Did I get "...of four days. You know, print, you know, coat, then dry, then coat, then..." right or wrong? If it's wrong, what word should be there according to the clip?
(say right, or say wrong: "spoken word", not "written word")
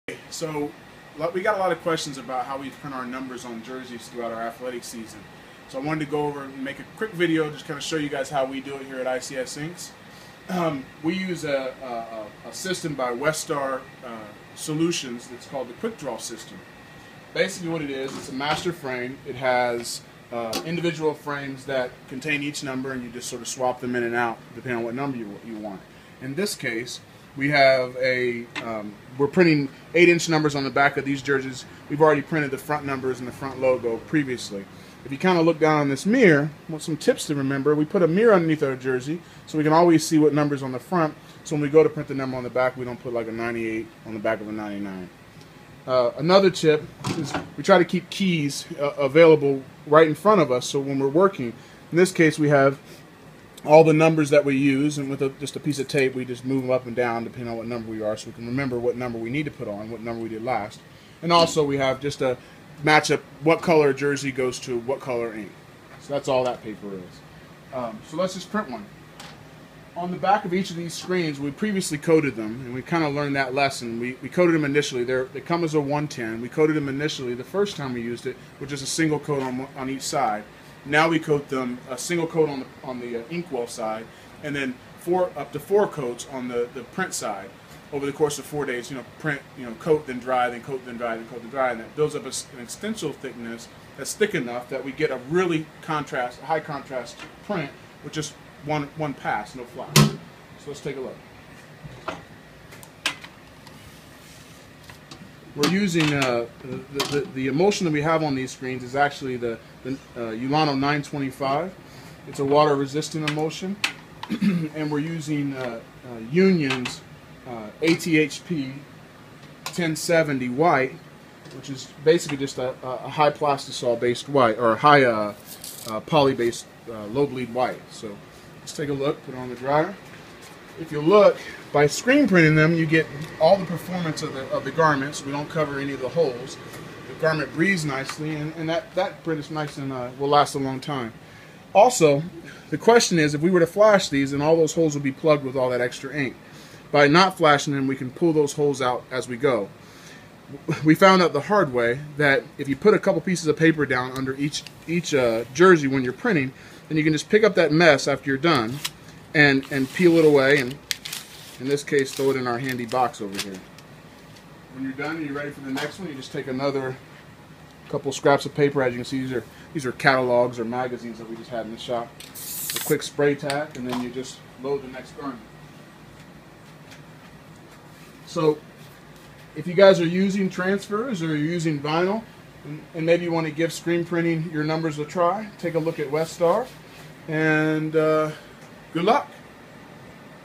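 right.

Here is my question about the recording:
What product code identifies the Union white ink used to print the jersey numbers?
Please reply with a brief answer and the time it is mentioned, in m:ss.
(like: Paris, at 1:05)
ATHP 1070, at 1:57.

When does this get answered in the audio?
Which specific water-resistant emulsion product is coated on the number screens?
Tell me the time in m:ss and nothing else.
1:50.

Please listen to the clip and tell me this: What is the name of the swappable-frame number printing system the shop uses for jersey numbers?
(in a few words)
Quick Draw System.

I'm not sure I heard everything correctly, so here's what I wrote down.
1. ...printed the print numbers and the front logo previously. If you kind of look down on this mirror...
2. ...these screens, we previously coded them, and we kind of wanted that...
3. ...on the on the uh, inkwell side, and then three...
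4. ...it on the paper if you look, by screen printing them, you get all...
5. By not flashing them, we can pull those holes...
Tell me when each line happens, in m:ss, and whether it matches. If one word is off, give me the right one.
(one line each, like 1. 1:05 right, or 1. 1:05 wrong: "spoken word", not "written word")
1. 0:32 wrong: "front", not "print"
2. 1:10 wrong: "learned", not "wanted"
3. 1:22 wrong: "four", not "three"
4. 2:09 wrong: "dryer", not "paper"
5. 2:26 right.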